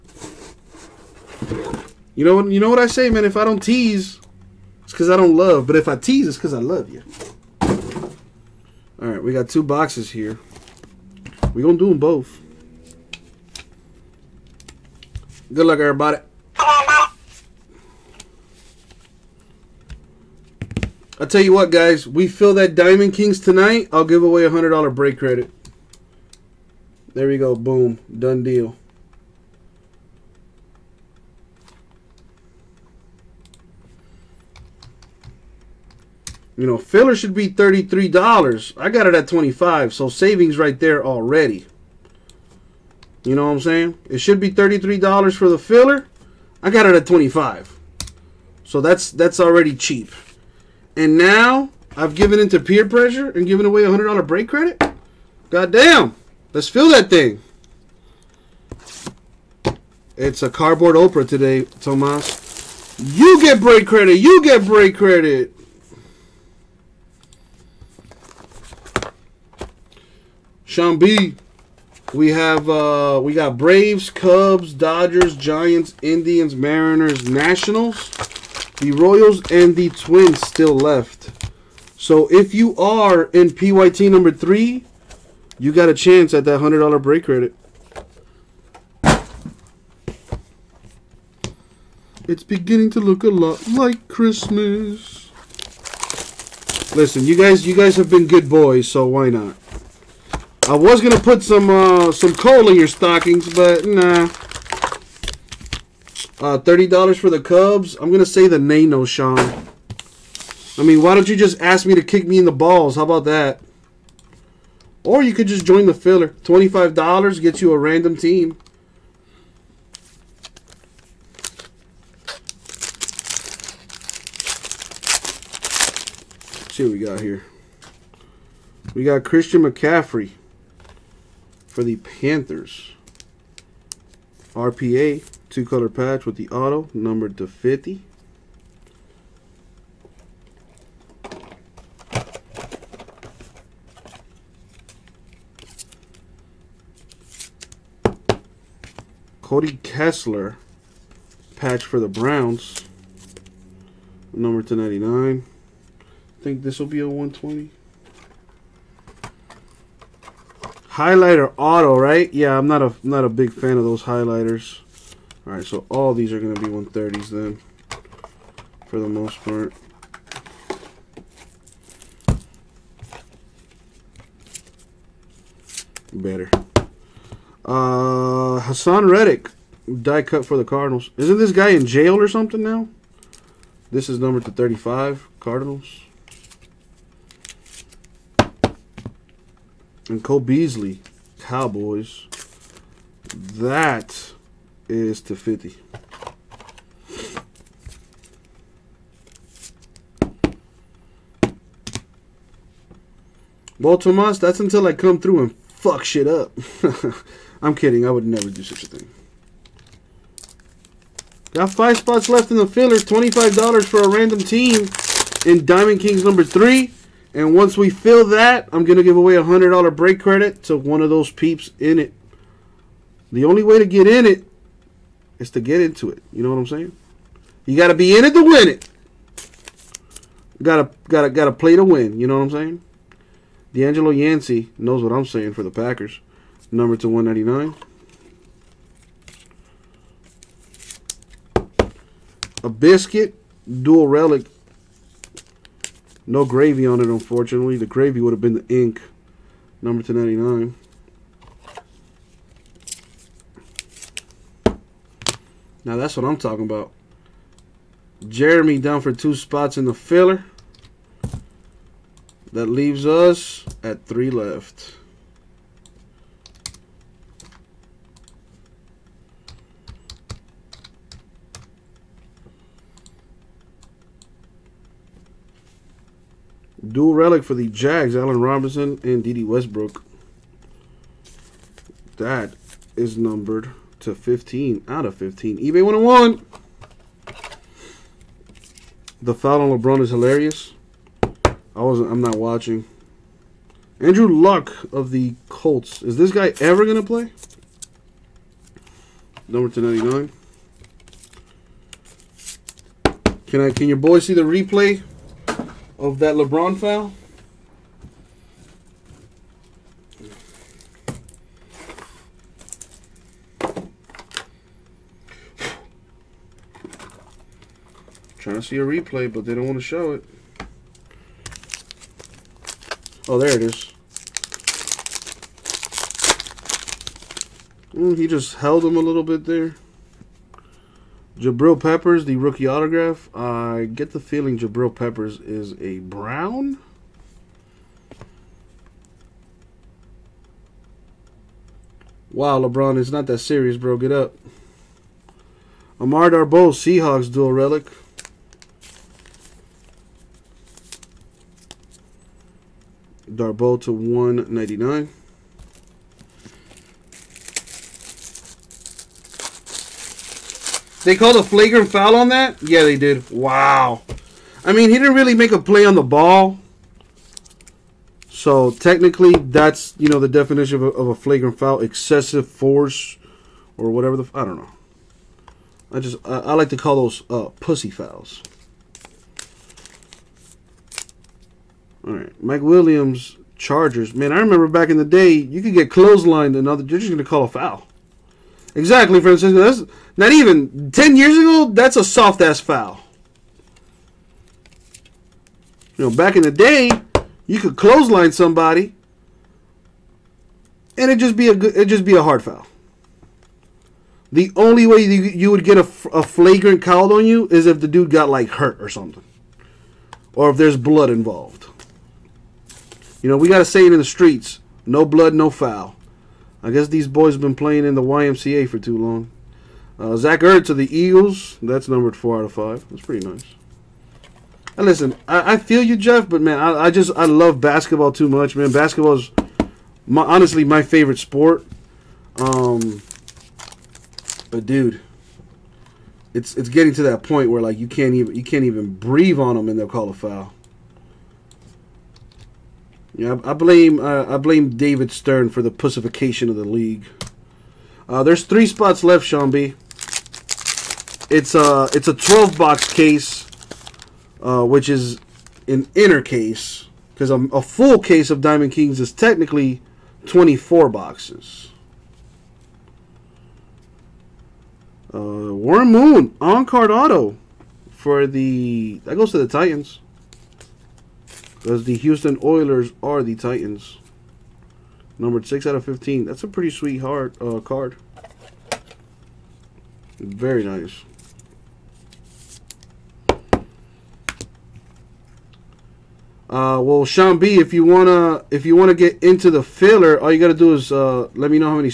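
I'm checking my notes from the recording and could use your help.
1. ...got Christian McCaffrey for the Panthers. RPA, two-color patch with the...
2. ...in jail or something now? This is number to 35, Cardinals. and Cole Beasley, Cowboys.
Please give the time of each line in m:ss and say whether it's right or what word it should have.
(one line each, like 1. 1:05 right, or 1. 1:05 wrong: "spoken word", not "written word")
1. 2:09 right
2. 3:01 right.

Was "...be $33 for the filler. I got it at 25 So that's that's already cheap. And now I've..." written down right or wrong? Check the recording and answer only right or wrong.
right.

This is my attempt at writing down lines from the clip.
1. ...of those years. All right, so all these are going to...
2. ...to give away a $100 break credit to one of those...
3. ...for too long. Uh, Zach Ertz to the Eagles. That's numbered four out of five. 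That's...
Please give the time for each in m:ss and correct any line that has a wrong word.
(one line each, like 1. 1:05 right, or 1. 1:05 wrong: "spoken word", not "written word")
1. 2:43 wrong: "highlighters", not "years"
2. 3:38 right
3. 6:58 right.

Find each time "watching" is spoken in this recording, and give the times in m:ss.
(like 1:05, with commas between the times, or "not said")
4:52.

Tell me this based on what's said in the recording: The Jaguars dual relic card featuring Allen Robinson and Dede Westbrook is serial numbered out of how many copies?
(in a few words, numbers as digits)
15.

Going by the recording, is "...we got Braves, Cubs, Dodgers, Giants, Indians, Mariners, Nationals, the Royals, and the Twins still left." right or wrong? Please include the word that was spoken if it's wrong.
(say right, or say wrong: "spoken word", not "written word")
right.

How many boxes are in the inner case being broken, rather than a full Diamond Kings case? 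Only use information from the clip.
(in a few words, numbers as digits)
12.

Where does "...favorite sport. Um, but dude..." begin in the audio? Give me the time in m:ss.
7:10.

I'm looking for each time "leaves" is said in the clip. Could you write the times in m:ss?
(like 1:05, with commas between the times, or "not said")
4:22.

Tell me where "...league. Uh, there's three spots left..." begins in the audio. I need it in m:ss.
7:26.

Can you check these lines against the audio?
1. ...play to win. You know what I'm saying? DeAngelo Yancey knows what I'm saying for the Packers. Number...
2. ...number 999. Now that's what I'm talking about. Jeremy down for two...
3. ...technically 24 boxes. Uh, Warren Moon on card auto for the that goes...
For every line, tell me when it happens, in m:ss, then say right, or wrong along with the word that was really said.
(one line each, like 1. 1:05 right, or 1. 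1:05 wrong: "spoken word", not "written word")
1. 3:51 right
2. 4:09 wrong: "299", not "999"
3. 7:39 right.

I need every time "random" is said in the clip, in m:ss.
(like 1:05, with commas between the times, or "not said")
1:57, 3:34.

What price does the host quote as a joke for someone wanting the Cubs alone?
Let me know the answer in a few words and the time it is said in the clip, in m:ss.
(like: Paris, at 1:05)
$30, at 1:46.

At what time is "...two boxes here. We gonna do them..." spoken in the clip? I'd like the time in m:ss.
0:09.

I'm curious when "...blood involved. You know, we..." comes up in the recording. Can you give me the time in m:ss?
6:50.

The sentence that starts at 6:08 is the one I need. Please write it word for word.
So technically, that's, you know, the definition of a, of a flagrant foul.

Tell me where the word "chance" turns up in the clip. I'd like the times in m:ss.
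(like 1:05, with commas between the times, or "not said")
1:25.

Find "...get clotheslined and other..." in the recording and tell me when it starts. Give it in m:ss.
6:25.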